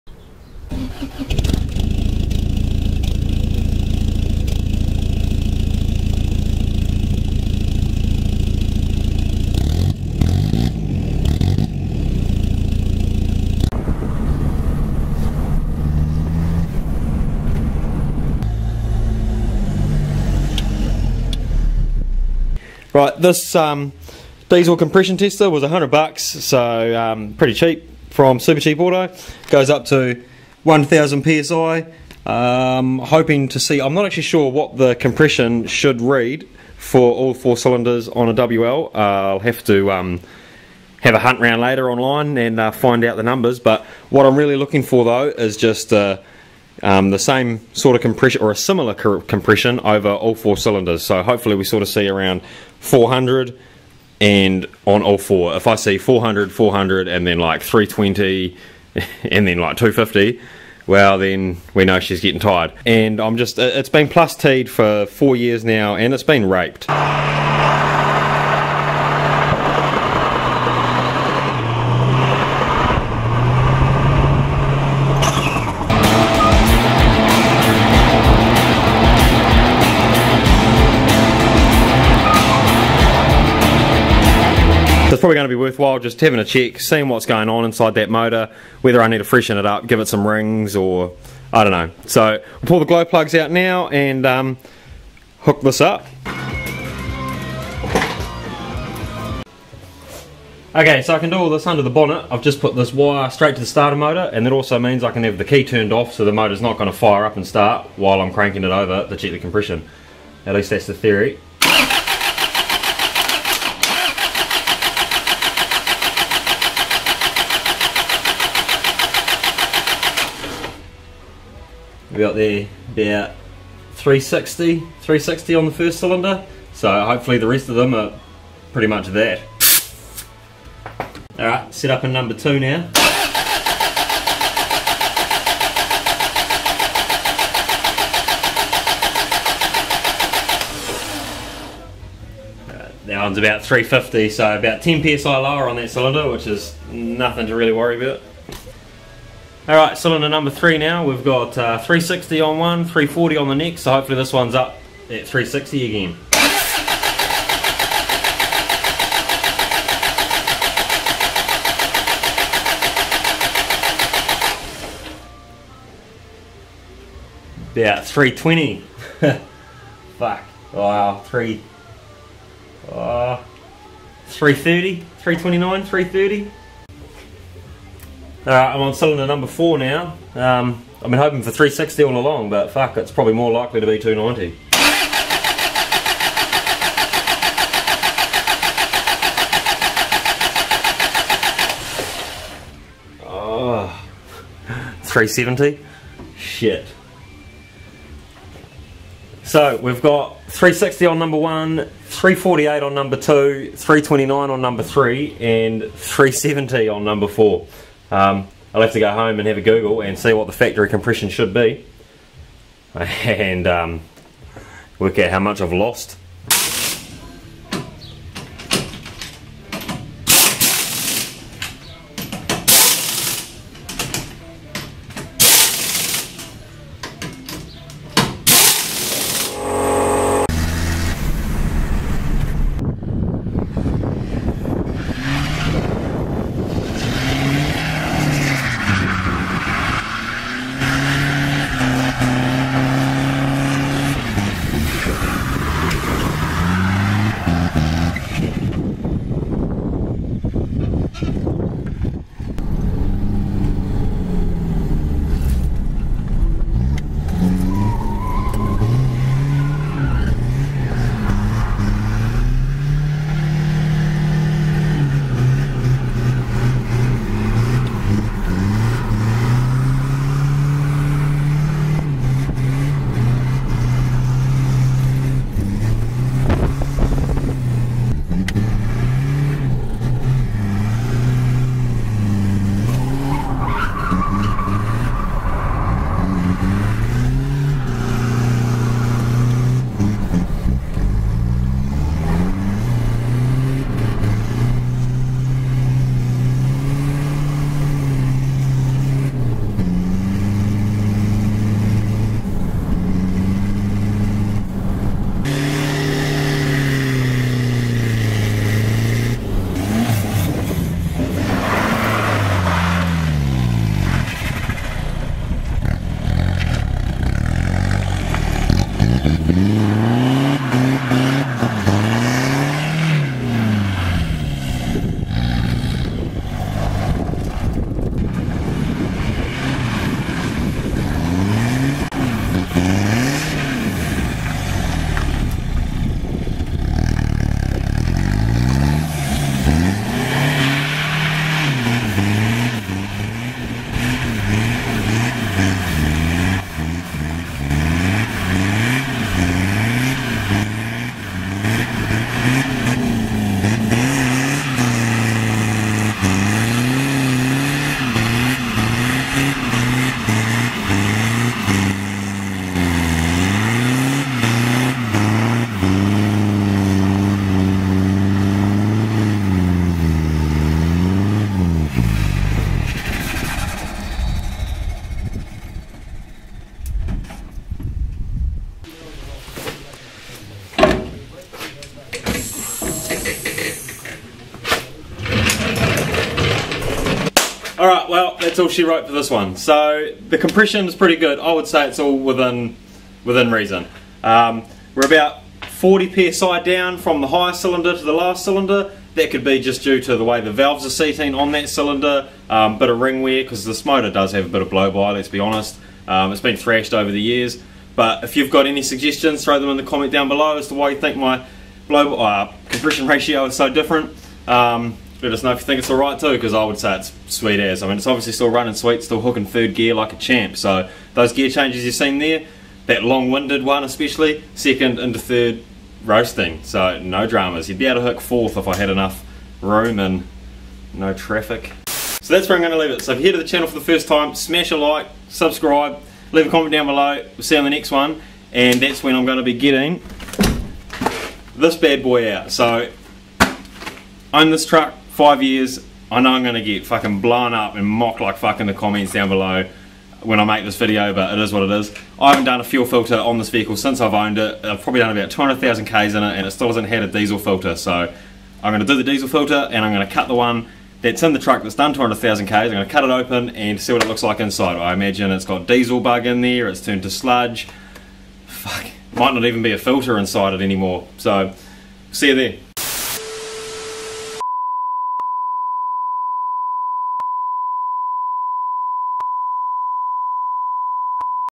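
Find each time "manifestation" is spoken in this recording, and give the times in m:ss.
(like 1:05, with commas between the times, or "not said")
not said.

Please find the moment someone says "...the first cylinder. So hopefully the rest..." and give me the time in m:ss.
2:05.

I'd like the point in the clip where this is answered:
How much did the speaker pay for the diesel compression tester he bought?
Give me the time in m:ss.
0:25.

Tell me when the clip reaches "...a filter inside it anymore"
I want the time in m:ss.
7:49.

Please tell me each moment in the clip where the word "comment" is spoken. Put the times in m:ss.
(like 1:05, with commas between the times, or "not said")
6:49, 7:16, 7:28.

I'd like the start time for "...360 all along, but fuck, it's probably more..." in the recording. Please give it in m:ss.
3:01.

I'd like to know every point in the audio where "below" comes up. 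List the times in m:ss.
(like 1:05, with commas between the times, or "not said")
6:50, 7:16, 7:29.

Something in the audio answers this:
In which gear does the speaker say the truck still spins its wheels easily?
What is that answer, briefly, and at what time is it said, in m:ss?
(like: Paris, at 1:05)
third gear, at 6:59.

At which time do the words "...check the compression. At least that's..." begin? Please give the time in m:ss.
1:49.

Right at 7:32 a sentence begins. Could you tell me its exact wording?
I haven't done a fuel filter on this vehicle since I've owned it.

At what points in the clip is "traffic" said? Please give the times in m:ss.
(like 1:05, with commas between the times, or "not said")
7:11.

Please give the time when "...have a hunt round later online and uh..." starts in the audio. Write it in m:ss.
0:41.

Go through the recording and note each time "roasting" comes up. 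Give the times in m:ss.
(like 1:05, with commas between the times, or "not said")
7:06.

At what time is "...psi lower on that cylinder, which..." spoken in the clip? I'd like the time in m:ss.
2:25.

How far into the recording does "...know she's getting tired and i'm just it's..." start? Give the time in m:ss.
1:01.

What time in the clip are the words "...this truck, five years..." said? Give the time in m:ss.
7:24.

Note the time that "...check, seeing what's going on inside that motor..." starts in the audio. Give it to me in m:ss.
1:26.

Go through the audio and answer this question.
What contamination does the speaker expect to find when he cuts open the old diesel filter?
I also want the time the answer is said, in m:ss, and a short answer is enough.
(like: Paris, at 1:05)
diesel bug, at 7:45.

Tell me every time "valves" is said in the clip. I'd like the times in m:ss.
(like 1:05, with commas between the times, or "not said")
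6:40.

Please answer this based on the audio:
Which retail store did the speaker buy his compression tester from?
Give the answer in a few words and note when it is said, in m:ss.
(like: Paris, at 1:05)
Super Cheap Auto, at 0:28.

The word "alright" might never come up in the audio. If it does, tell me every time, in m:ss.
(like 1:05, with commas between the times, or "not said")
2:29, 2:58, 6:27, 6:55.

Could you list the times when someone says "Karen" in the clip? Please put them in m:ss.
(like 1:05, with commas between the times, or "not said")
not said.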